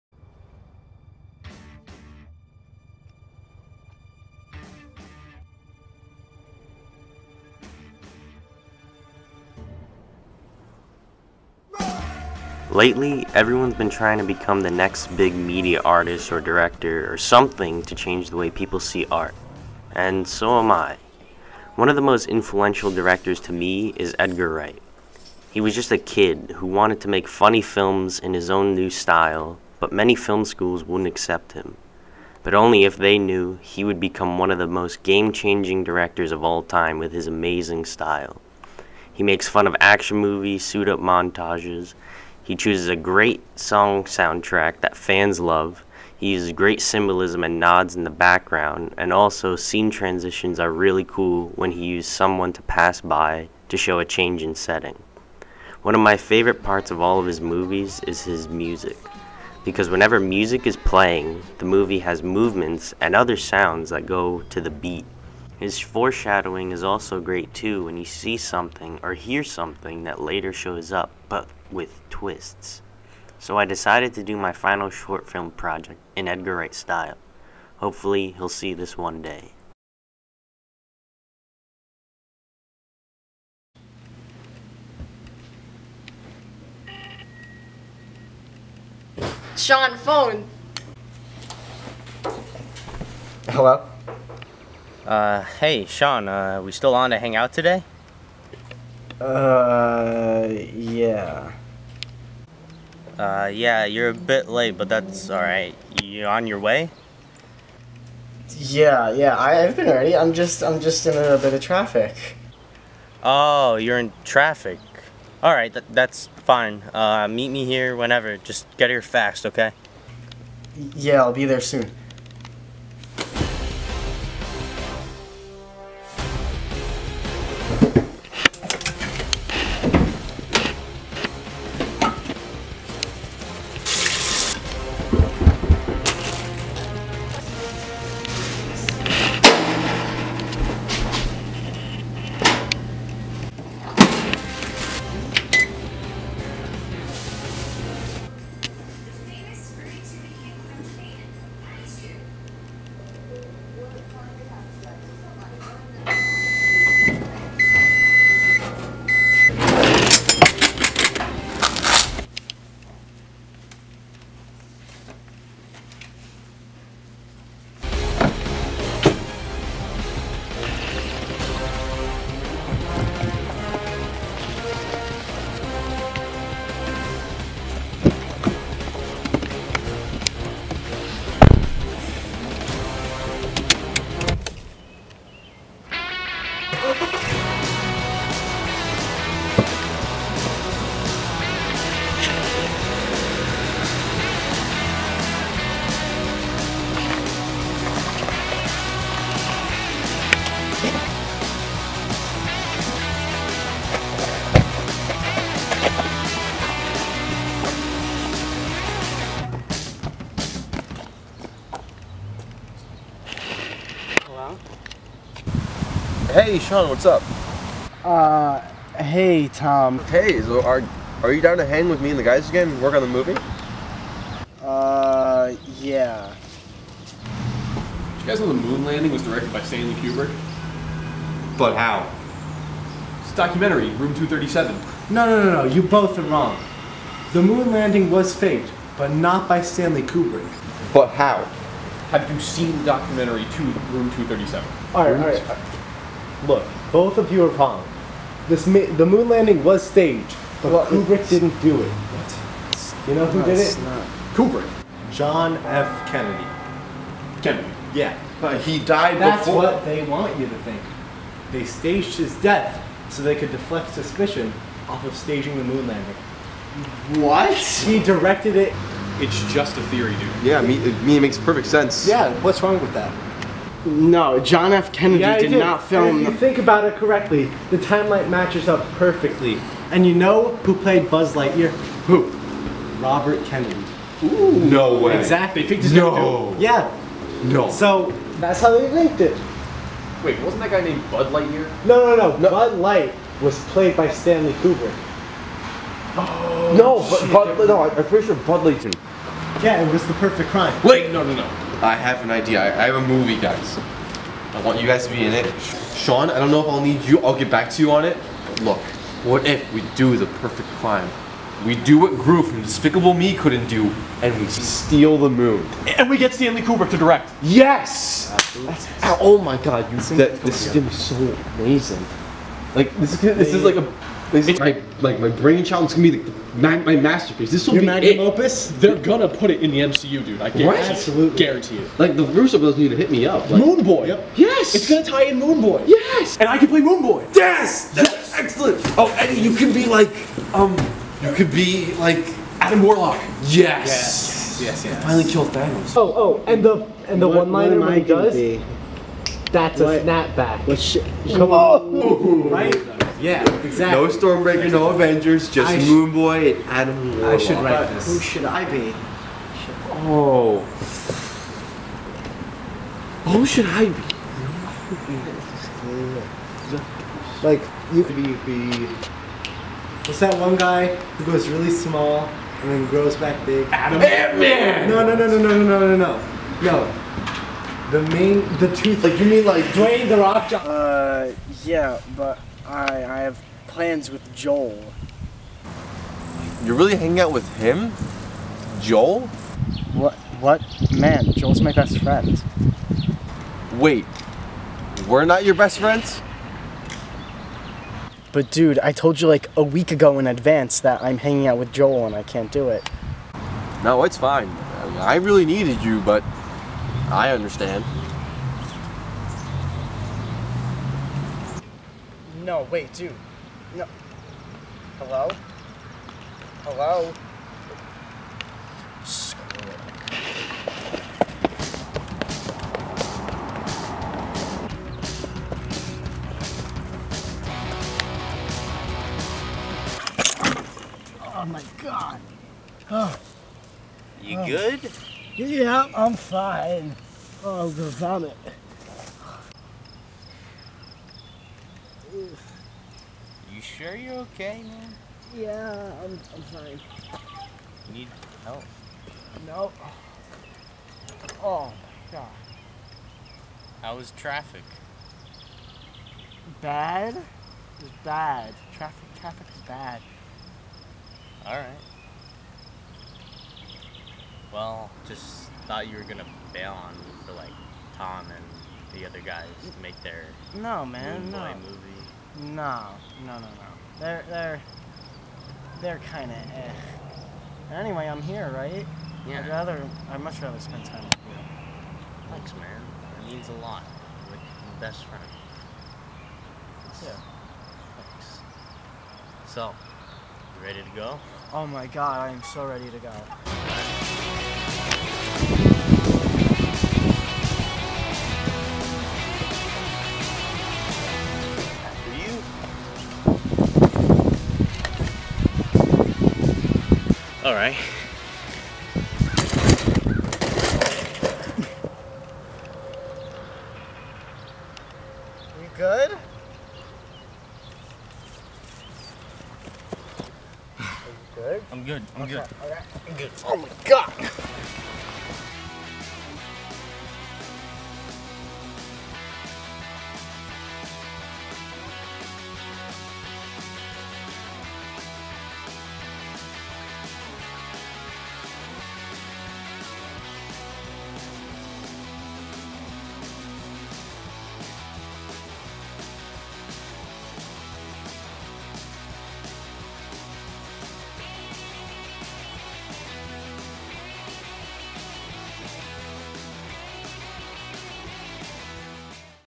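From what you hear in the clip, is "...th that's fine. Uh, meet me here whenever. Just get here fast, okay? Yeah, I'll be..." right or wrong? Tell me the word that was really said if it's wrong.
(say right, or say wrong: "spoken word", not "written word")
right.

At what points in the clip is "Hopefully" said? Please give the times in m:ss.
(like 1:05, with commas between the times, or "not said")
1:17.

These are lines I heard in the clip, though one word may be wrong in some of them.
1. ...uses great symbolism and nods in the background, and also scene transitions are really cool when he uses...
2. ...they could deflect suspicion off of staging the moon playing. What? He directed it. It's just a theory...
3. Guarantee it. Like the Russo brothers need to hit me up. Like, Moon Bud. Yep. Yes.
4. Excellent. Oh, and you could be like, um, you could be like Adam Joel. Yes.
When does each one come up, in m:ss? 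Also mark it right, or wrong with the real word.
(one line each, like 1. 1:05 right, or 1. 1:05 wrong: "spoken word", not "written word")
1. 0:46 right
2. 4:23 wrong: "landing", not "playing"
3. 5:31 wrong: "Boy", not "Bud"
4. 5:38 wrong: "Warlock", not "Joel".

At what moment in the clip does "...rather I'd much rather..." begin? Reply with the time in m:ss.
7:59.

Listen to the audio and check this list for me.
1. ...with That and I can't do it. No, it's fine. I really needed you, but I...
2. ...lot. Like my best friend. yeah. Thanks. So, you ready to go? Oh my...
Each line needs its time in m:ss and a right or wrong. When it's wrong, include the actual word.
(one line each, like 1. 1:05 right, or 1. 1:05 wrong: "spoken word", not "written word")
1. 6:41 wrong: "Joel", not "That"
2. 8:03 right.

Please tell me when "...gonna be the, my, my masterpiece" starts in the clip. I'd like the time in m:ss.
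5:25.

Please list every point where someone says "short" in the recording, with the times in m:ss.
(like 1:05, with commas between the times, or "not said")
1:14.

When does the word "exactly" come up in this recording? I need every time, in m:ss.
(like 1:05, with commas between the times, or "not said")
4:45, 5:53.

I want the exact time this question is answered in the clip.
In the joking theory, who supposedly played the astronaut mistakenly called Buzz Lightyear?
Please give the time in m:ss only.
4:43.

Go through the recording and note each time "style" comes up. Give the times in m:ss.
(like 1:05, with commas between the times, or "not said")
0:28, 0:37, 1:16.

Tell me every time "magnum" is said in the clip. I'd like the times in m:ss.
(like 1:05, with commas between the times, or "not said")
5:27.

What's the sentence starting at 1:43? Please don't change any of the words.
Uh, yeah, you're a bit late, but that's alright.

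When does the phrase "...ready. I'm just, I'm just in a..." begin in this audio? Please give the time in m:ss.
1:49.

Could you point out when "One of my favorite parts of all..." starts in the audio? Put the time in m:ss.
0:55.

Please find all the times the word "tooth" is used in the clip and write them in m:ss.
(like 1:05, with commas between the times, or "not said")
6:18.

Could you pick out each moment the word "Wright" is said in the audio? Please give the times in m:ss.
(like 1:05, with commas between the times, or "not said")
0:24, 1:16.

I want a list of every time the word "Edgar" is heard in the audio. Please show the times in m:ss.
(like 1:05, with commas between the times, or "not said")
0:24, 1:16.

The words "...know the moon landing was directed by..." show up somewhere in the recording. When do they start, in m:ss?
3:48.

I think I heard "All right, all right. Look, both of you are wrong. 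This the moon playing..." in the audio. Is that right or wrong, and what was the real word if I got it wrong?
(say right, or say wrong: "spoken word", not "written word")
wrong: "landing", not "playing".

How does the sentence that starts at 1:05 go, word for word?
His foreshadowing is also great too when you see something or hear something that later shows up, but with twists.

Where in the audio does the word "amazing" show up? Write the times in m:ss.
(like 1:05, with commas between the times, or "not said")
0:37, 5:21.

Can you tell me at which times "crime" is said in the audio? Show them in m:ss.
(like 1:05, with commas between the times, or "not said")
5:00, 5:10.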